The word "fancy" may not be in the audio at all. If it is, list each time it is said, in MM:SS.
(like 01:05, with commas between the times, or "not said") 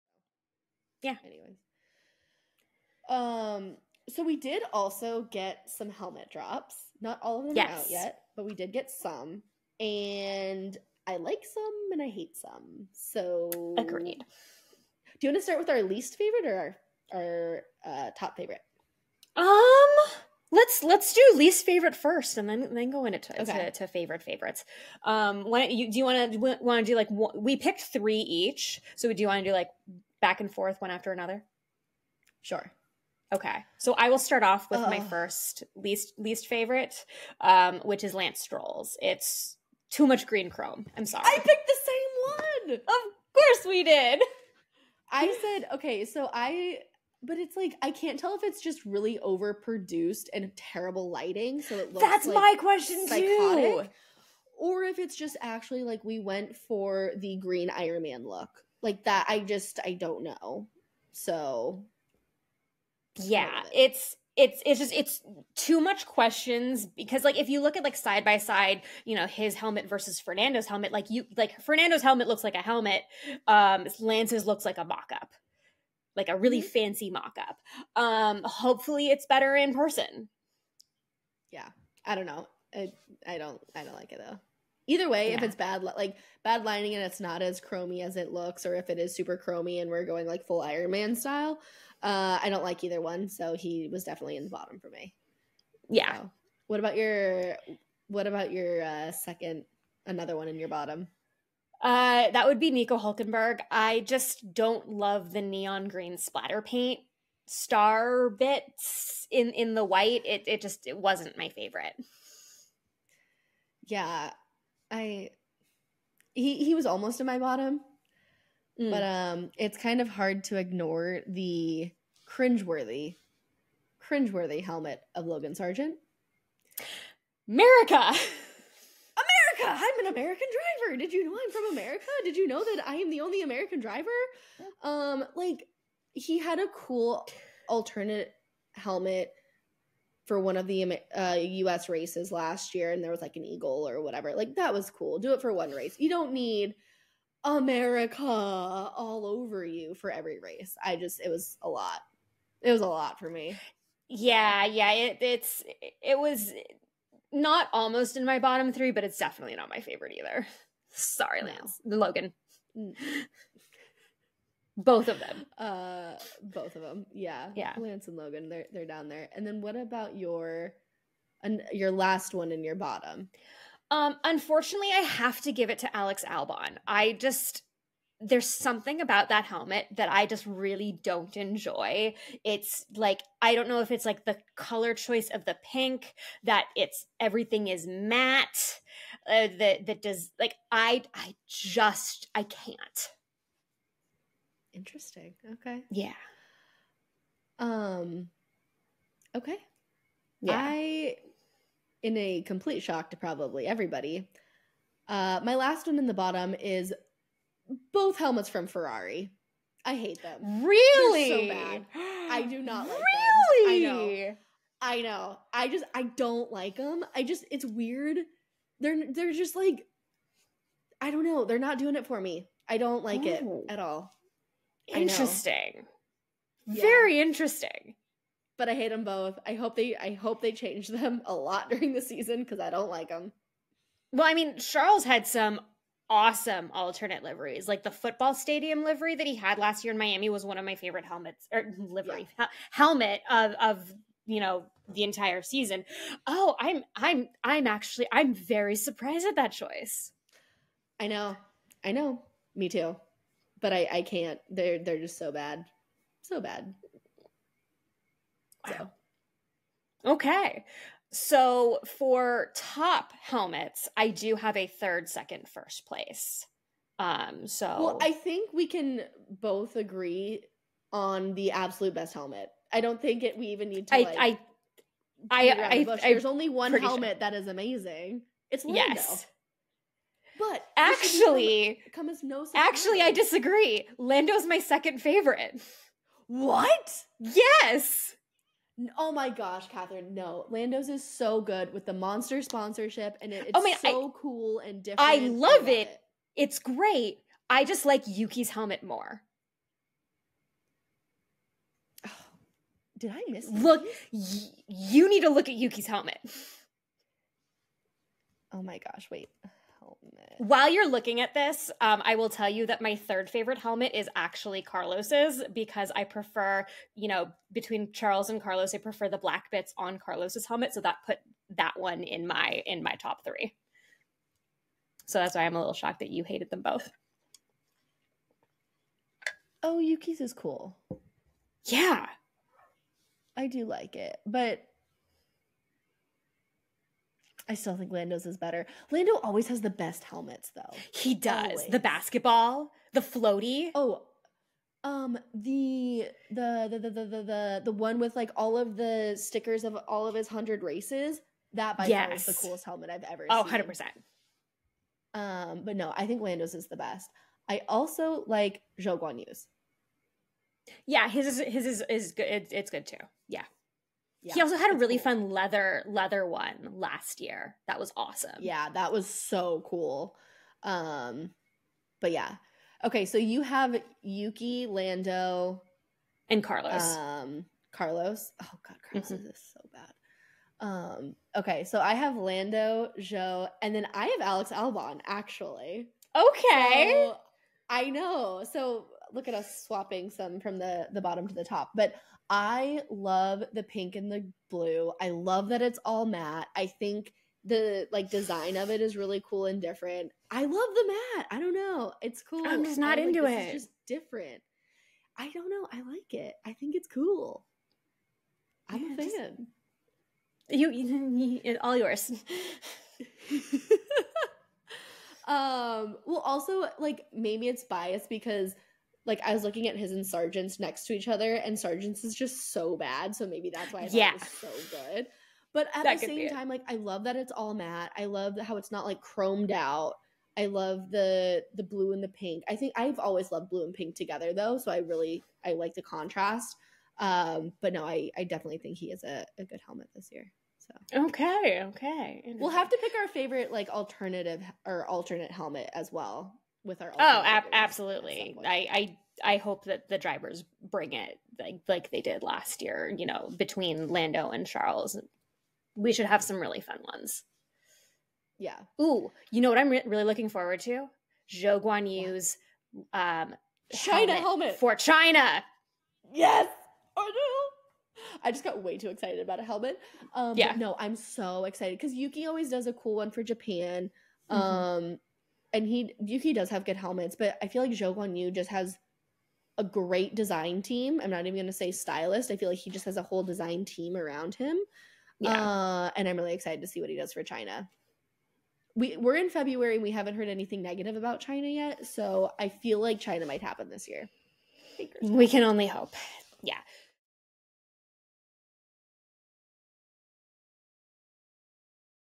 01:16.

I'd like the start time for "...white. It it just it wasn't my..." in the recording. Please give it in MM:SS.
01:49.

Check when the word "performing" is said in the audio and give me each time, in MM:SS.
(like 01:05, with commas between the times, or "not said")
not said.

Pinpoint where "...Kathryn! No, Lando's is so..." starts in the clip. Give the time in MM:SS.
04:49.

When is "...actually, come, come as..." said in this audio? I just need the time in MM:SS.
04:40.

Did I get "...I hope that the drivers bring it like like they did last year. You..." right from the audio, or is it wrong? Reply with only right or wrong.
right.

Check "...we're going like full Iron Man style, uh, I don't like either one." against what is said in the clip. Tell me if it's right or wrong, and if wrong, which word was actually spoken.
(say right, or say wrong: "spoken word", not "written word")
right.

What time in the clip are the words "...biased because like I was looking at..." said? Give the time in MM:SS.
06:57.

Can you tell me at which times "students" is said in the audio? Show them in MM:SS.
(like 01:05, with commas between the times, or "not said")
not said.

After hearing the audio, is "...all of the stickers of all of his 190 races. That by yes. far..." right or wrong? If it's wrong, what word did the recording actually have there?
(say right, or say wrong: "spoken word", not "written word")
wrong: "100", not "190".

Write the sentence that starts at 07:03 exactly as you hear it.
So maybe that's why I yeah.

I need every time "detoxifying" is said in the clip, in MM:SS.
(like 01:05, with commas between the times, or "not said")
not said.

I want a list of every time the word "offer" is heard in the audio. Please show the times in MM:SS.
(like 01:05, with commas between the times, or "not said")
not said.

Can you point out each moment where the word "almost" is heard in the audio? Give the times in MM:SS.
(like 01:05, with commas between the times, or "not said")
01:56, 02:37.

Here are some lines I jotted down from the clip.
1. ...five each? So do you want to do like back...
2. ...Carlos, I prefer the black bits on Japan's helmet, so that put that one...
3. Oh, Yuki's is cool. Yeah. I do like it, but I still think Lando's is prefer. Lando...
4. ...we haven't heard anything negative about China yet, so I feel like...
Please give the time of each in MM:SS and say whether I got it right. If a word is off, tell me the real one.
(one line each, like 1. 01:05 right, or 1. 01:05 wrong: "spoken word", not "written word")
1. 00:27 wrong: "three", not "five"
2. 05:18 wrong: "Carlos", not "Japan"
3. 05:29 wrong: "better", not "prefer"
4. 08:09 right.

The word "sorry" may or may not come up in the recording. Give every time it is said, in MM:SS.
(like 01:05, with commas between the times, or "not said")
00:41, 02:40.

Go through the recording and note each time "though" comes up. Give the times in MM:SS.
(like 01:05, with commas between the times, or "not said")
01:24, 05:40, 07:14.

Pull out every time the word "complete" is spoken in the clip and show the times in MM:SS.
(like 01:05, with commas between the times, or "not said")
03:22.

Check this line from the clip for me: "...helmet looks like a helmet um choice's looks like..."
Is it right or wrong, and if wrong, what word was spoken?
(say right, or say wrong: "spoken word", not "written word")
wrong: "lance", not "choice".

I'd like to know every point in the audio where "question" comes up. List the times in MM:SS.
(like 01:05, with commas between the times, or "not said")
00:52, 01:06.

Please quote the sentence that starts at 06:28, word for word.
So look at us swapping some from the the bottom to the top.